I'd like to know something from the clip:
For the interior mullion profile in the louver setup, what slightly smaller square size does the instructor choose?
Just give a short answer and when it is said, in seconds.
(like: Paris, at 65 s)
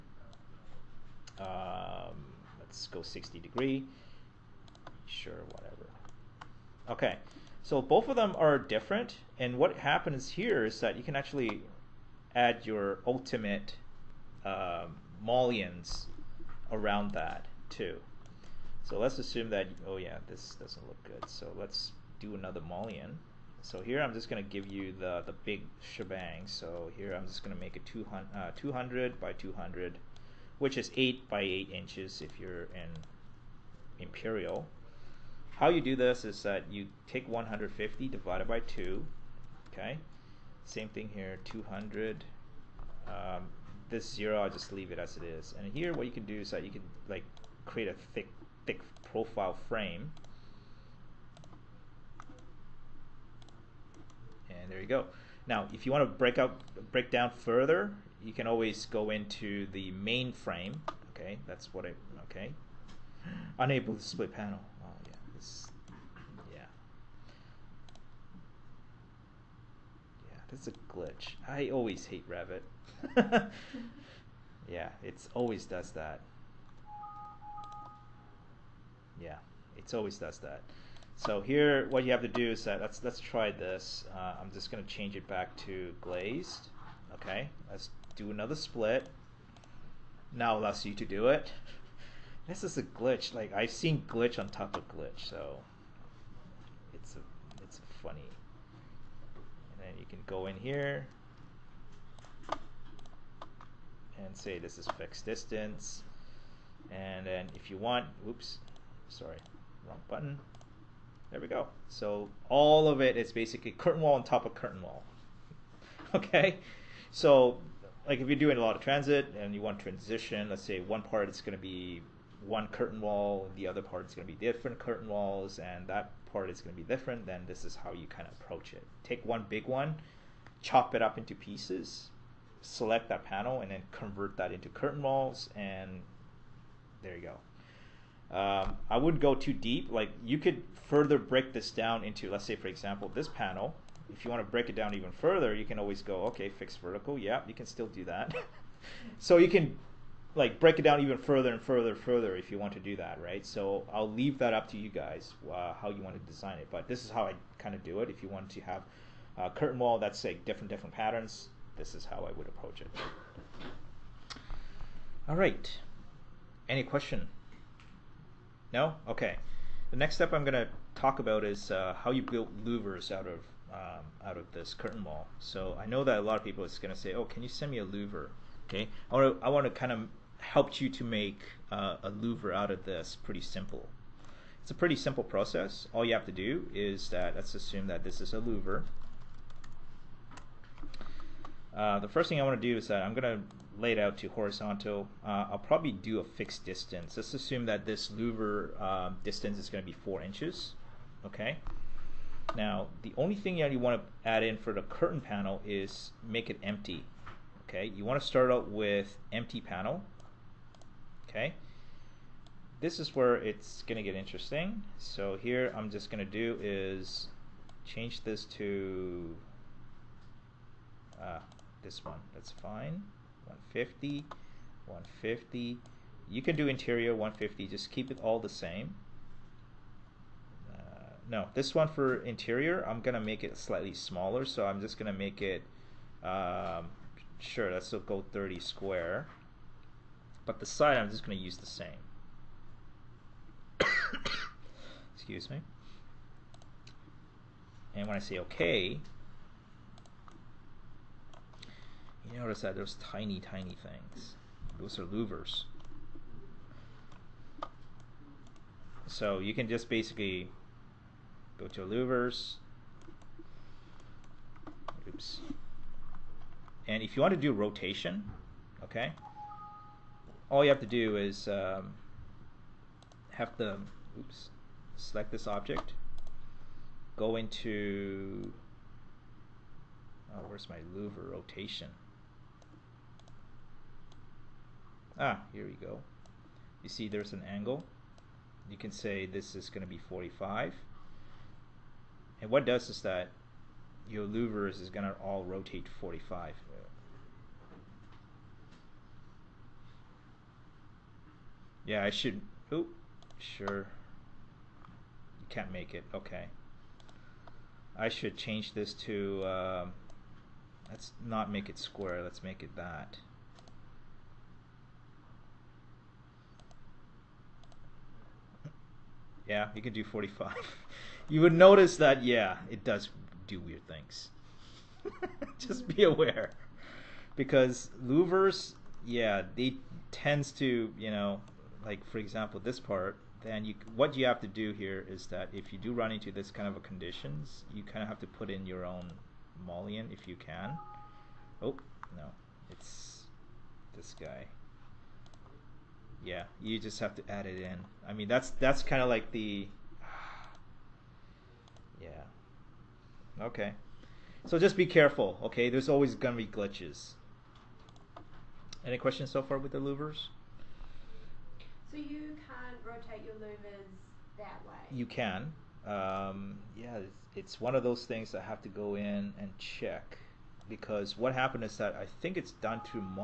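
30, at 238 s.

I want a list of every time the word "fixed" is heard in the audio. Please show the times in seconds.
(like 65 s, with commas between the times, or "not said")
104 s, 146 s, 196 s.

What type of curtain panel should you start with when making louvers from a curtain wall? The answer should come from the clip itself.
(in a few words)
Empty panel.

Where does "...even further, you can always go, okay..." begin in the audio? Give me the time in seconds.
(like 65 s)
144 s.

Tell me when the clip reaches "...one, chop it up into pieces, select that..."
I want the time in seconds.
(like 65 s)
129 s.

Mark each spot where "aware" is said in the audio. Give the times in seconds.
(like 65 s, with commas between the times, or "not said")
326 s.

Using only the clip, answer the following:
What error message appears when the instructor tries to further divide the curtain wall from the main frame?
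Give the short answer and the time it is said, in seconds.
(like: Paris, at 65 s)
Unable to split panel, at 63 s.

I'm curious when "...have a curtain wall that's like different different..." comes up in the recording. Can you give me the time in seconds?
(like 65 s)
158 s.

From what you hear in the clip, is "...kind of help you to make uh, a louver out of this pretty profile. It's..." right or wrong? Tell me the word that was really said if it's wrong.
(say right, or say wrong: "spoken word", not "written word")
wrong: "simple", not "profile".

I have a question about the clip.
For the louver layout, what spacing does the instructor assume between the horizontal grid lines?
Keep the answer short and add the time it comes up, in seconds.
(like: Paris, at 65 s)
4 inches, at 200 s.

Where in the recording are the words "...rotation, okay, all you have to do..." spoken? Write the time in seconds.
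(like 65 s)
267 s.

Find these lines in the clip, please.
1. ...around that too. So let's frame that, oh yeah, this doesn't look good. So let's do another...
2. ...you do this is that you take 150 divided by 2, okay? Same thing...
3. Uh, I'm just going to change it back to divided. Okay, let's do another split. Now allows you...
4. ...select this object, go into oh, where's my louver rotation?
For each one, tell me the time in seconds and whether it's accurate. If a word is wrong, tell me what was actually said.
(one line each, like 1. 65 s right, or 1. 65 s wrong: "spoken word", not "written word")
1. 16 s wrong: "assume", not "frame"
2. 35 s right
3. 84 s wrong: "glazed", not "divided"
4. 274 s right.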